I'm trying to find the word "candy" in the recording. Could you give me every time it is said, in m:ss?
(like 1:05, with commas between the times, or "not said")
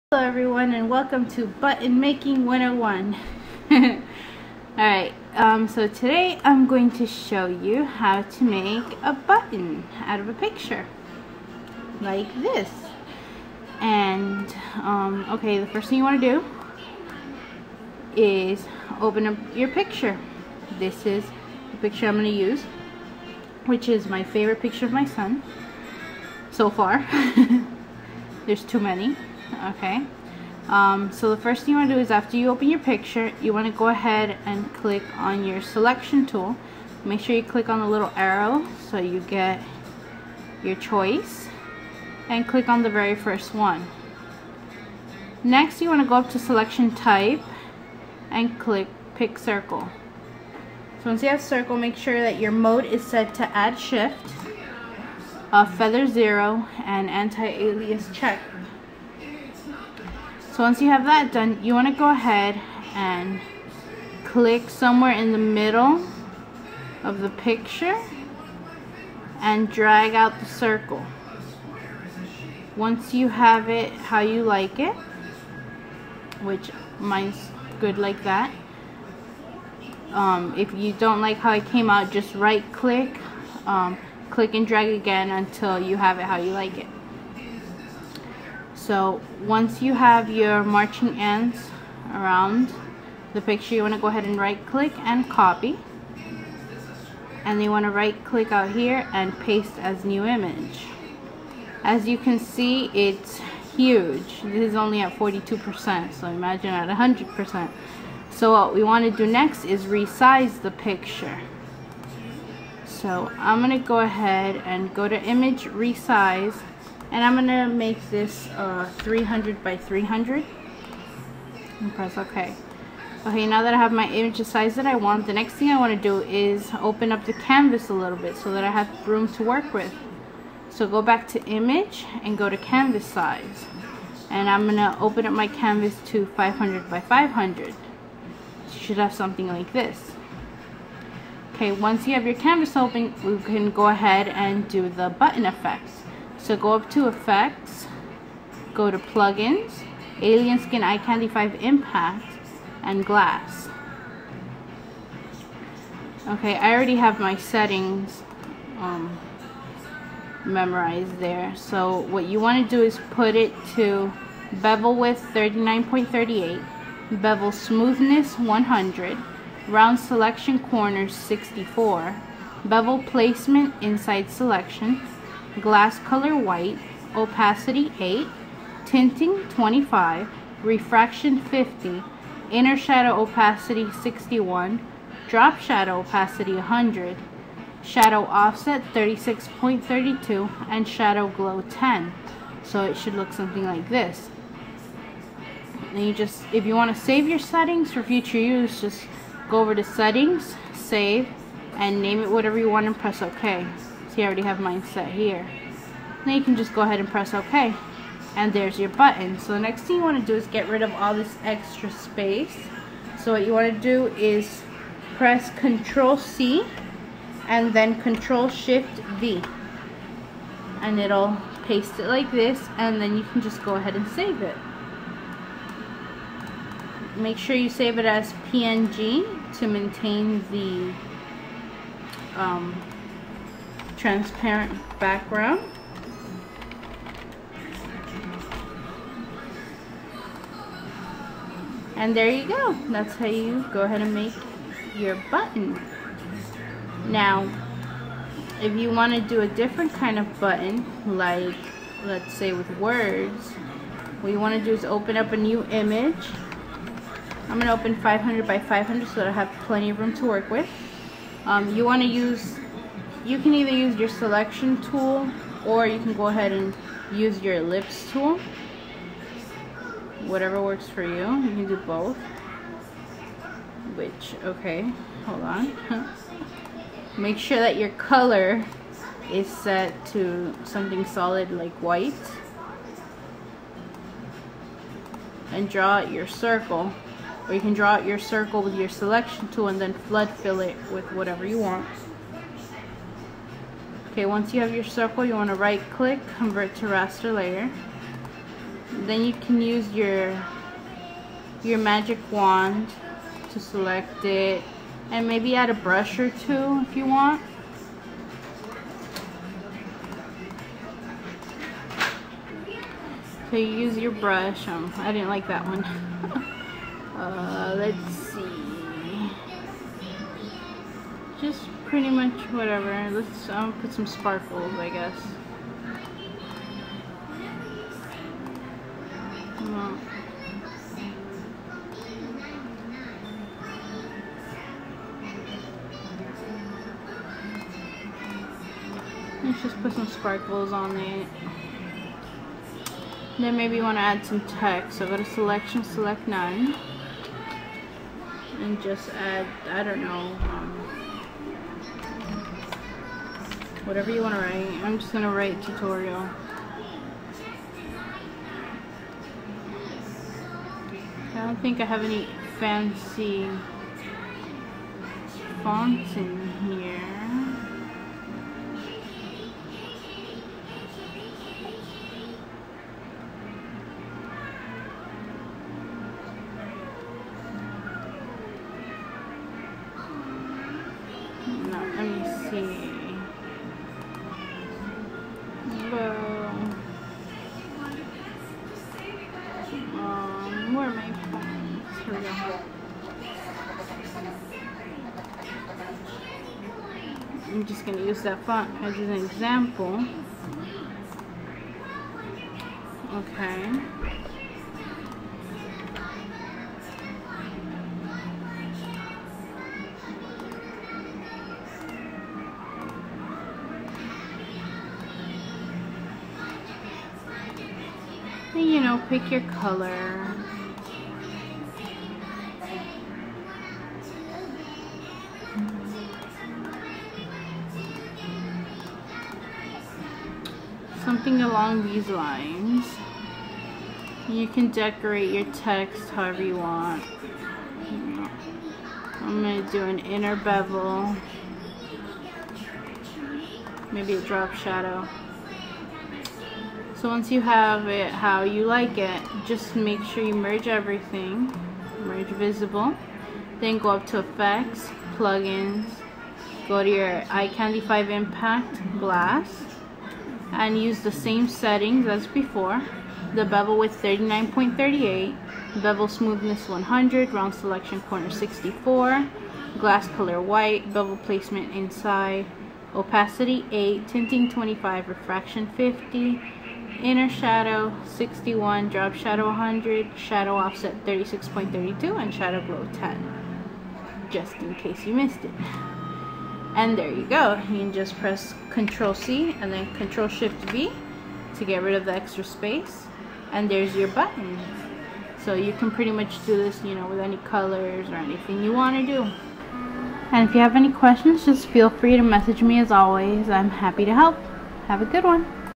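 2:30, 7:37.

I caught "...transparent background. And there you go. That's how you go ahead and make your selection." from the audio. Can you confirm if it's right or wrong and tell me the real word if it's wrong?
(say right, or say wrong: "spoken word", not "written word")
wrong: "button", not "selection".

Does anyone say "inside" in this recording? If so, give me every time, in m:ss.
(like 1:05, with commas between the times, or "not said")
2:53, 7:51.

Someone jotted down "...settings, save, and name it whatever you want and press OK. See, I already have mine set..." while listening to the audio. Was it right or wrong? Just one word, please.
right.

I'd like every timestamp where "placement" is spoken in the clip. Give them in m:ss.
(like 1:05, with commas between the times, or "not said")
2:53, 7:51.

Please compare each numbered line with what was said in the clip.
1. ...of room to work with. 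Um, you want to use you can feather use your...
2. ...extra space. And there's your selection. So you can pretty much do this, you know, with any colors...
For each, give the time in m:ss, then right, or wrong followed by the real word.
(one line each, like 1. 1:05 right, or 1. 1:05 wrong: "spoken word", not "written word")
1. 4:19 wrong: "either", not "feather"
2. 8:12 wrong: "button", not "selection".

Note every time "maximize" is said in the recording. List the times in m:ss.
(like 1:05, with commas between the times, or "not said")
not said.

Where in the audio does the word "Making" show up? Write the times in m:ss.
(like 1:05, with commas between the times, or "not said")
0:01.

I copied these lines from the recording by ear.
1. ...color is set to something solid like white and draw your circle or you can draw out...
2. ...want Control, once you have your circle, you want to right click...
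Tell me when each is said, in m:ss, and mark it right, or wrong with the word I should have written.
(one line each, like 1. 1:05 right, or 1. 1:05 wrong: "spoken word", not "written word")
1. 4:37 right
2. 4:51 wrong: "Okay", not "Control".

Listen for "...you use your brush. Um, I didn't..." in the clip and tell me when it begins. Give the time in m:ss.
5:13.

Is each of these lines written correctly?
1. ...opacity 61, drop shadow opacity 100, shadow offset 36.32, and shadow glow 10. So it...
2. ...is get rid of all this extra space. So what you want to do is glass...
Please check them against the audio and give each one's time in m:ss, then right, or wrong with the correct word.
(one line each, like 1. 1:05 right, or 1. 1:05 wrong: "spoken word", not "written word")
1. 3:03 right
2. 3:30 wrong: "press", not "glass".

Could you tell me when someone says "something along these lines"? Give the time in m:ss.
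7:11.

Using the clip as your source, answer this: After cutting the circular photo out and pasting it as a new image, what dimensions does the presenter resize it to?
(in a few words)
300 by 300.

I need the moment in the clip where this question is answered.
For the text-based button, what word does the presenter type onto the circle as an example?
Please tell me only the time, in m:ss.
5:55.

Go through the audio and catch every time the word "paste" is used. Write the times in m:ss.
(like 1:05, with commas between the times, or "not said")
1:39, 3:41.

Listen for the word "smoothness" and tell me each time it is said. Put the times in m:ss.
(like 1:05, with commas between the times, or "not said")
2:47, 7:46.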